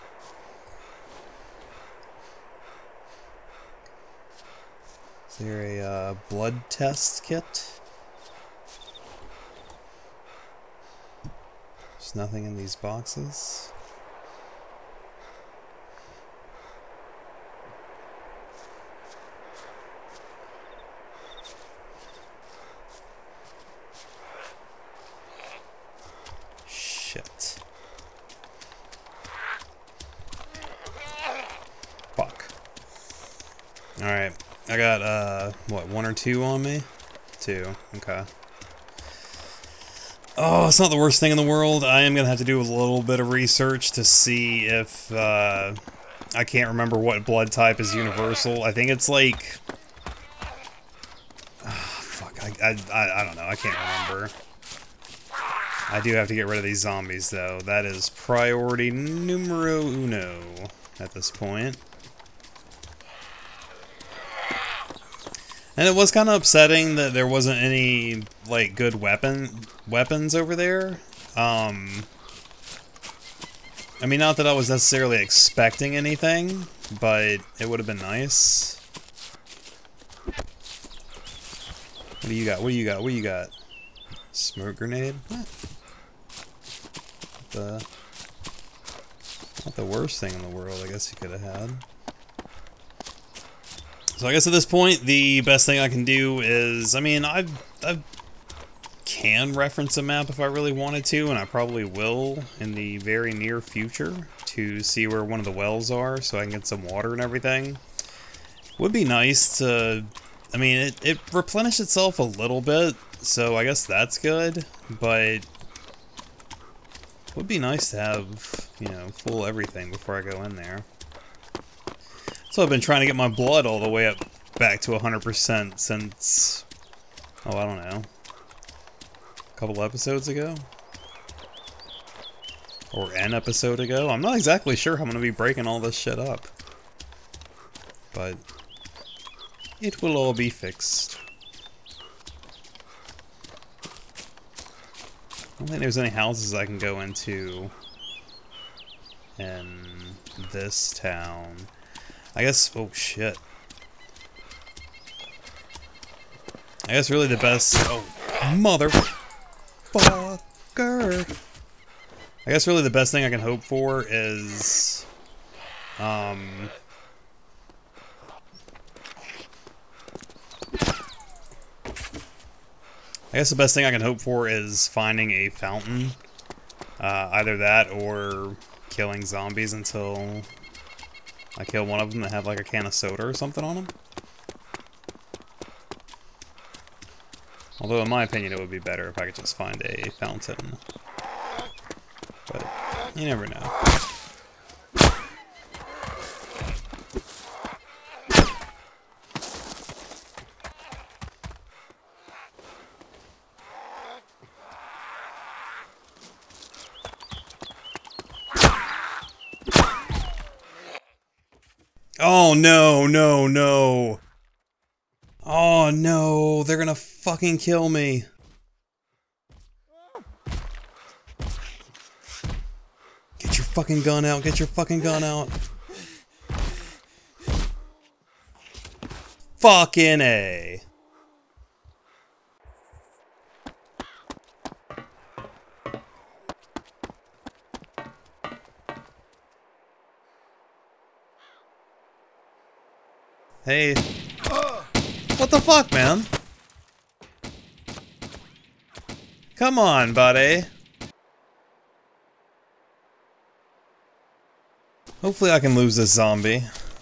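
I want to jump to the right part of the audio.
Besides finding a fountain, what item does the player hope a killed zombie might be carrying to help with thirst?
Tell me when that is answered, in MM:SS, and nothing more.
03:02.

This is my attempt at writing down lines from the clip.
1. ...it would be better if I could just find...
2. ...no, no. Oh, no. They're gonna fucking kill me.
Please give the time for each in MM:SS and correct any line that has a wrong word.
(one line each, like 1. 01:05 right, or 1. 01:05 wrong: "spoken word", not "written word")
1. 03:08 right
2. 03:33 right.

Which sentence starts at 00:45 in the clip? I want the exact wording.
Uh, I can't remember what blood type is universal.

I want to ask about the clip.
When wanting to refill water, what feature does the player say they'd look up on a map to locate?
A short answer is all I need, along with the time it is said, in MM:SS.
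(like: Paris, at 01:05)
Wells, at 01:45.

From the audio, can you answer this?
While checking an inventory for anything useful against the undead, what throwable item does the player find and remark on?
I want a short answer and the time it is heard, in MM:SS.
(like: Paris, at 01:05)
Smoke grenade, at 01:24.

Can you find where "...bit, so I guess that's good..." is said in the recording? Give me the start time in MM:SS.
01:52.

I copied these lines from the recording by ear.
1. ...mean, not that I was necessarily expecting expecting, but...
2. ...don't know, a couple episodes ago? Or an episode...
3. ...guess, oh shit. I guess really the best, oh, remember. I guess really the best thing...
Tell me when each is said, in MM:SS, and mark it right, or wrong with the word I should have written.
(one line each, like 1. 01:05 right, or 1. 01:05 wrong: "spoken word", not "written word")
1. 01:14 wrong: "anything", not "expecting"
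2. 02:07 right
3. 02:32 wrong: "motherfucker", not "remember".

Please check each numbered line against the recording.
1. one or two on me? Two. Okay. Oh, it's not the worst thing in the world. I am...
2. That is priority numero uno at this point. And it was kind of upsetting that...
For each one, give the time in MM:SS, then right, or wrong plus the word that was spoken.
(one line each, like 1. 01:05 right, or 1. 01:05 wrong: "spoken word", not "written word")
1. 00:36 right
2. 00:57 right.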